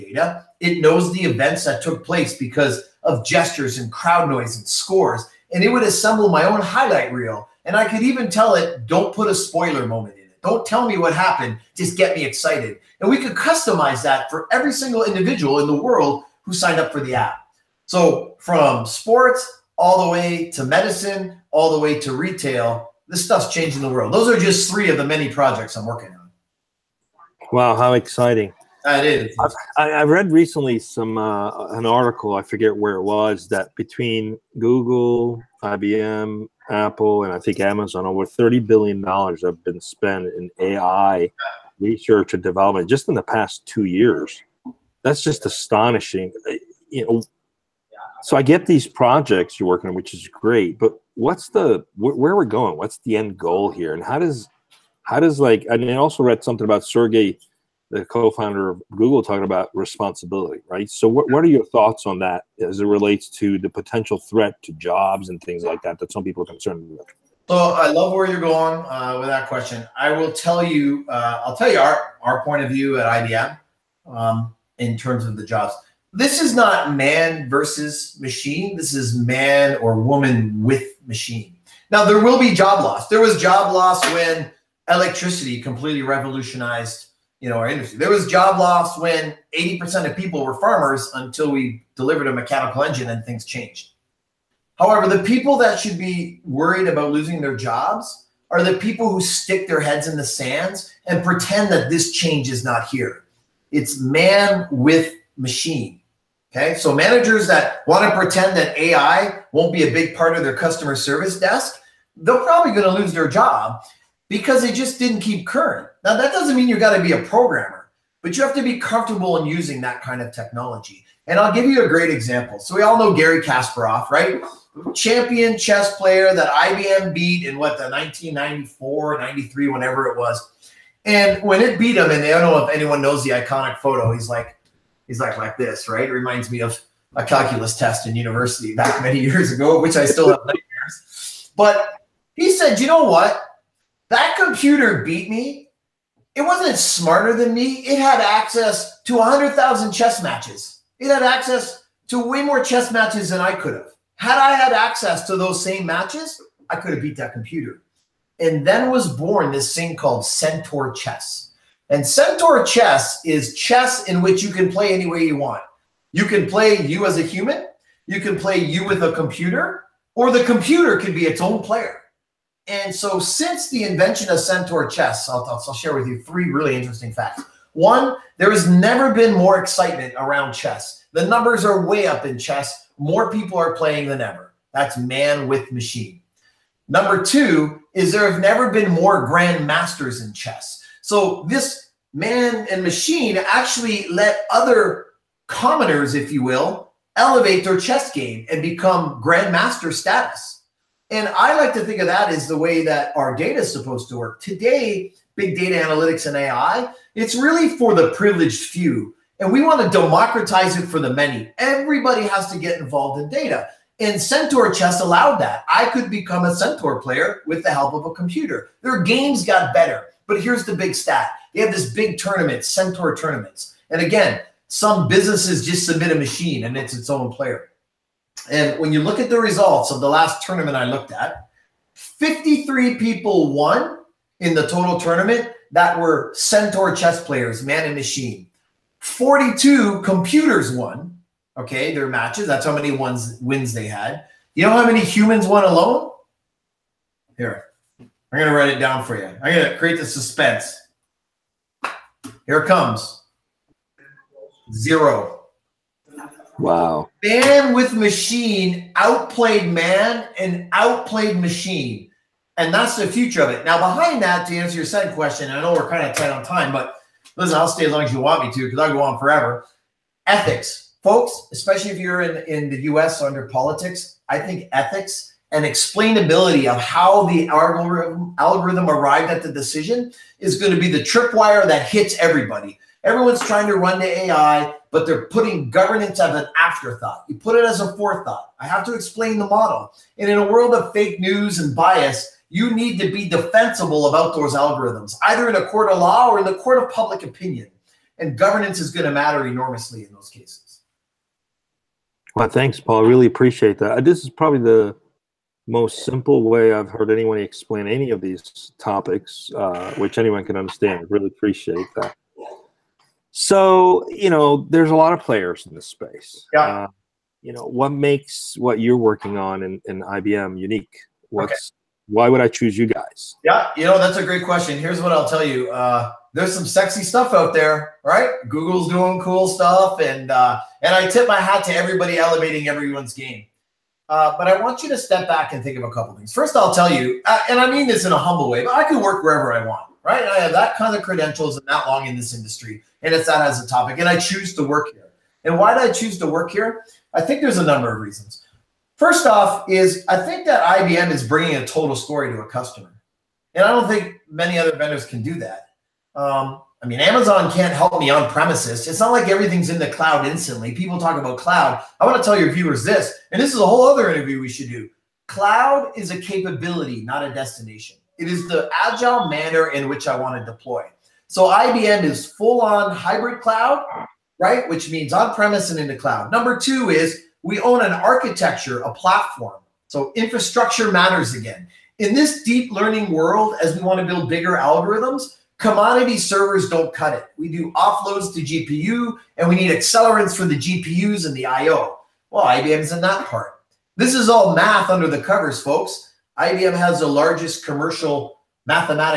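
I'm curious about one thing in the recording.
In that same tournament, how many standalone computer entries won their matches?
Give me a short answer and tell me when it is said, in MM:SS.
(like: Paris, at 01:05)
42, at 03:58.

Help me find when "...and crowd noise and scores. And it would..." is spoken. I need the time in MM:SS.
00:03.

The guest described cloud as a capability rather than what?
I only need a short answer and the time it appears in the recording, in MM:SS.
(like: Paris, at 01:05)
a destination, at 06:07.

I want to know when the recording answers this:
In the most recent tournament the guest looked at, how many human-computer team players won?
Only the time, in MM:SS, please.
03:51.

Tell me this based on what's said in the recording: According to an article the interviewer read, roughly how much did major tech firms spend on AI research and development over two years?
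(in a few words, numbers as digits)
over $30 billion.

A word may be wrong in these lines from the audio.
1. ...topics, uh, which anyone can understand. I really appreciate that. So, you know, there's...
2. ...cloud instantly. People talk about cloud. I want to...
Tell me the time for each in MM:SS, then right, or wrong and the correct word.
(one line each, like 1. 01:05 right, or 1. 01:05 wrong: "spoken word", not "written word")
1. 05:08 right
2. 05:59 right.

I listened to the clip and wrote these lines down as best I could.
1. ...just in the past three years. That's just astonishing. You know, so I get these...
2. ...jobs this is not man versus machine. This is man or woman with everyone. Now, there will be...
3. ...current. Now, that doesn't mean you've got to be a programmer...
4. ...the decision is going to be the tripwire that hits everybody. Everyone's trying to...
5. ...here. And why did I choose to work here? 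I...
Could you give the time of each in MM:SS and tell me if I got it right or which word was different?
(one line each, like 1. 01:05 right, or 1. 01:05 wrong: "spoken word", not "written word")
1. 00:42 wrong: "two", not "three"
2. 01:15 wrong: "machine", not "everyone"
3. 01:55 right
4. 04:39 right
5. 05:44 right.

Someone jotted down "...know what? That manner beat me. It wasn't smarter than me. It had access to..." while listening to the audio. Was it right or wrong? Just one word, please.
wrong.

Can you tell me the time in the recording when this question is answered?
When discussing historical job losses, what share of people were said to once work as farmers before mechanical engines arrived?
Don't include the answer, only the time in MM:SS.
01:29.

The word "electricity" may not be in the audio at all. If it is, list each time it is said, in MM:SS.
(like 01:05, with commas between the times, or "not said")
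01:24.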